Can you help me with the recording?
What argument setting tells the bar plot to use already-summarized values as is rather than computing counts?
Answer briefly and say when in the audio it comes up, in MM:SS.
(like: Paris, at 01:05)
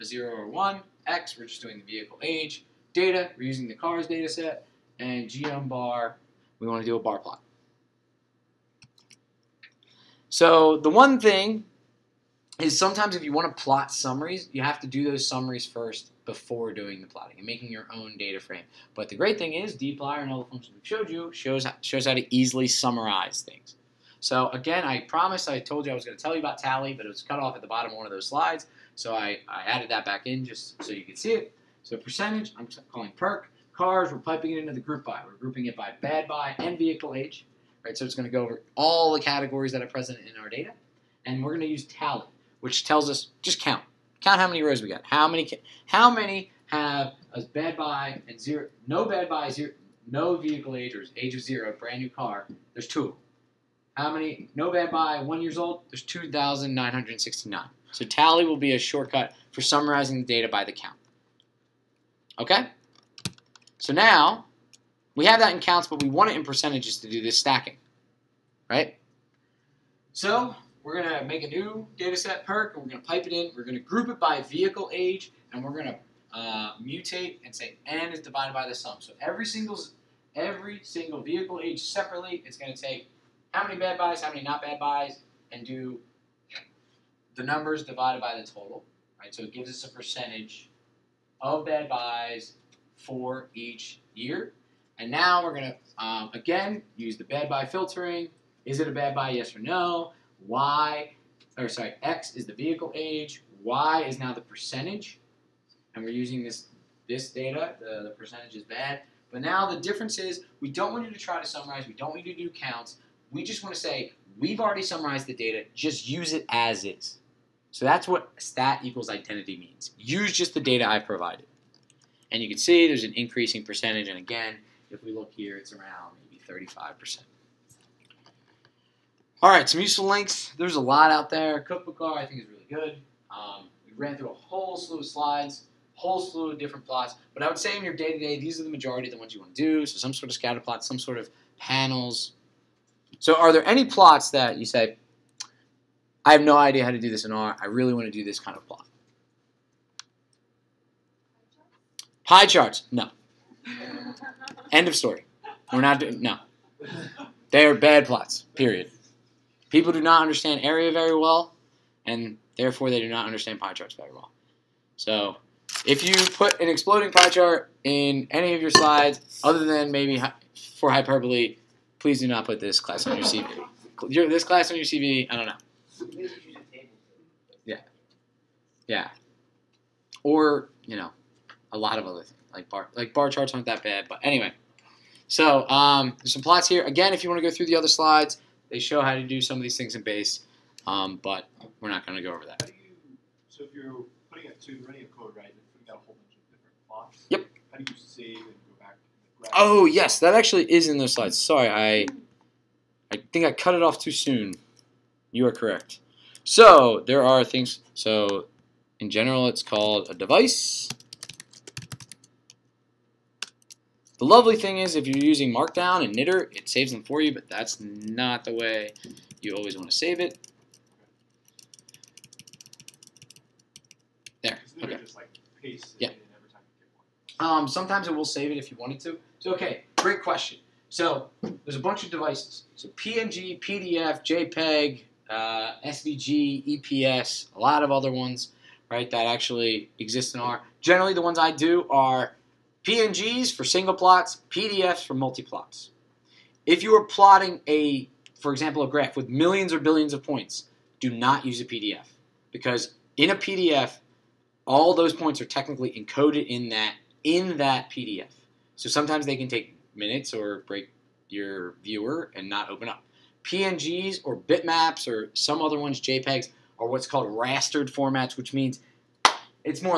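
stat equals identity, at 01:58.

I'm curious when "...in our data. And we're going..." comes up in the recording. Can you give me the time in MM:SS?
00:40.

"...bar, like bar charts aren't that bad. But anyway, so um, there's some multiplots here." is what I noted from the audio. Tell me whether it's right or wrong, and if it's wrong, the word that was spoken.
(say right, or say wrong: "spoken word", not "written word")
wrong: "plots", not "multiplots".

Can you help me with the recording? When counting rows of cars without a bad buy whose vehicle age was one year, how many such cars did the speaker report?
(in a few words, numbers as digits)
2969.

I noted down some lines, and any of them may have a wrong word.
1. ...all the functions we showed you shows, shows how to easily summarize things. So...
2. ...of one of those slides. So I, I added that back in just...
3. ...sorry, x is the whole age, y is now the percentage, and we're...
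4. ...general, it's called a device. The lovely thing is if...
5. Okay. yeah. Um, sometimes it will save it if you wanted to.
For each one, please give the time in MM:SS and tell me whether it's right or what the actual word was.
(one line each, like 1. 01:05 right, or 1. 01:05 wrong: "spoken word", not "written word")
1. 00:20 right
2. 00:27 right
3. 01:41 wrong: "vehicle", not "whole"
4. 03:29 right
5. 03:44 right.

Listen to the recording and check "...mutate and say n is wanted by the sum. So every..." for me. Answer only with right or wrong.
wrong.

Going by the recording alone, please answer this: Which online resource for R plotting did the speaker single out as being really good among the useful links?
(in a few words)
Cookbook R.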